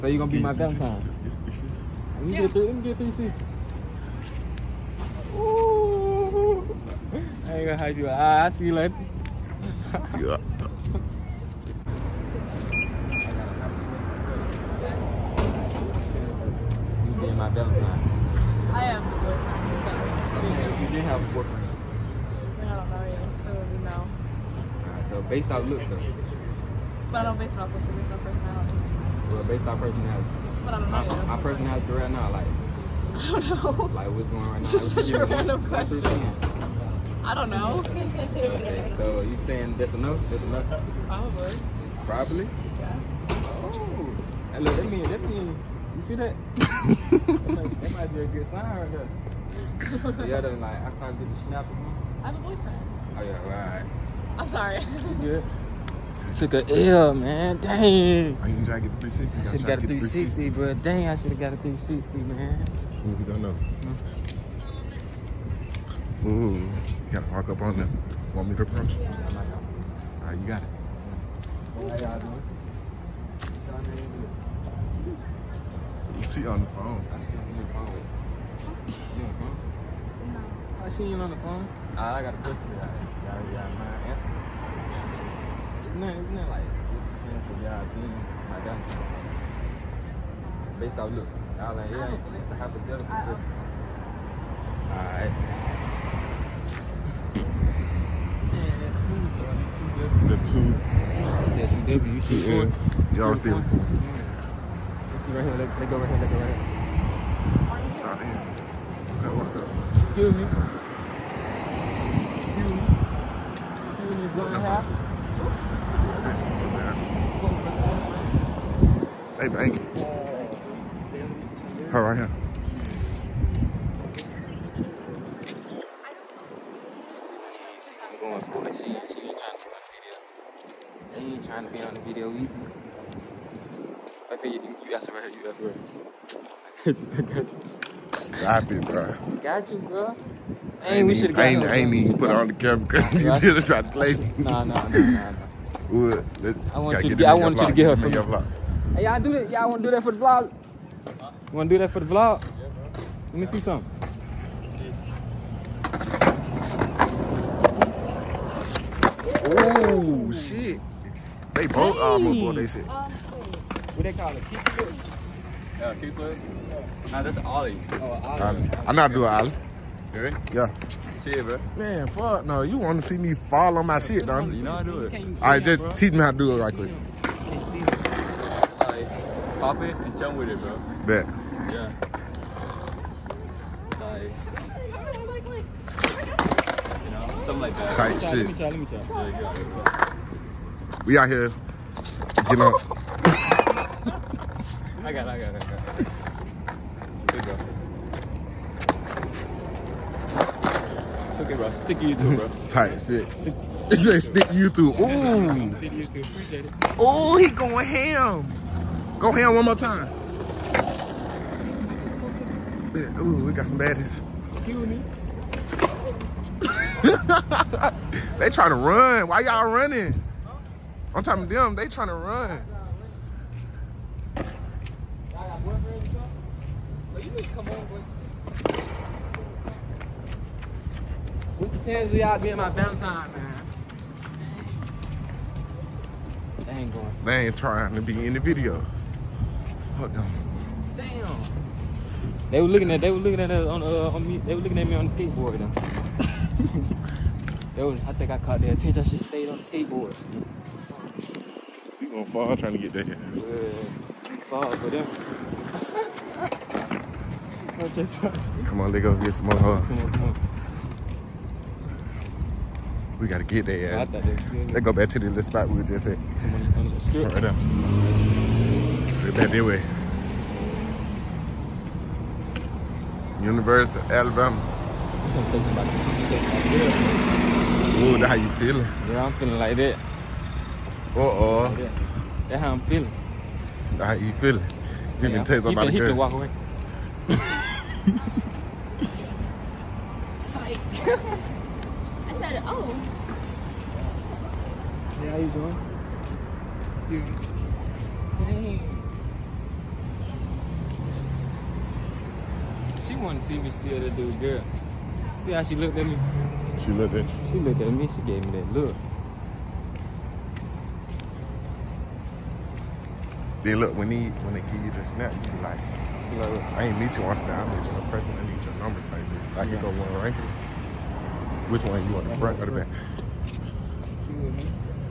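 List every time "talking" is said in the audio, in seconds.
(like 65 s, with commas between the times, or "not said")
221 s.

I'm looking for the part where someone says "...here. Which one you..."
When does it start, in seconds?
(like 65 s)
320 s.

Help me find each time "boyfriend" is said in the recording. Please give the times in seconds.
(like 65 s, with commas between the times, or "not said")
21 s, 52 s.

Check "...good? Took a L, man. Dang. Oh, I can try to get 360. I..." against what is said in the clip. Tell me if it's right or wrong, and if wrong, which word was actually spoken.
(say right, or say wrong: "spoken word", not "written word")
right.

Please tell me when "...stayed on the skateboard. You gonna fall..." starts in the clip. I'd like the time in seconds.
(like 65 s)
249 s.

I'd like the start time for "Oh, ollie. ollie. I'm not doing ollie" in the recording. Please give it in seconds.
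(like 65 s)
167 s.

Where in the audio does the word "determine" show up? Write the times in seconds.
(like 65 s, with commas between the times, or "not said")
not said.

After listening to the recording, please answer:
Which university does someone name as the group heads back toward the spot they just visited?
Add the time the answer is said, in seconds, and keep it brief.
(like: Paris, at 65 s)
University of Alabama, at 273 s.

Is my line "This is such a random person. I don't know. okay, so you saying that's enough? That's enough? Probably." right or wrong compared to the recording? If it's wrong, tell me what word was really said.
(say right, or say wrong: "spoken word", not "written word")
wrong: "question", not "person".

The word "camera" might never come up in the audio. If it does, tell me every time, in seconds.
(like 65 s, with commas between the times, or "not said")
142 s.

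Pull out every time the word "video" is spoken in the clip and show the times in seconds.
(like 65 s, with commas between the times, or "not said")
132 s, 238 s.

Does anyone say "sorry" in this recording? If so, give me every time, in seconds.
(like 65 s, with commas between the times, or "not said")
54 s.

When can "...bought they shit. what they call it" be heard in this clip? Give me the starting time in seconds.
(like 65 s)
162 s.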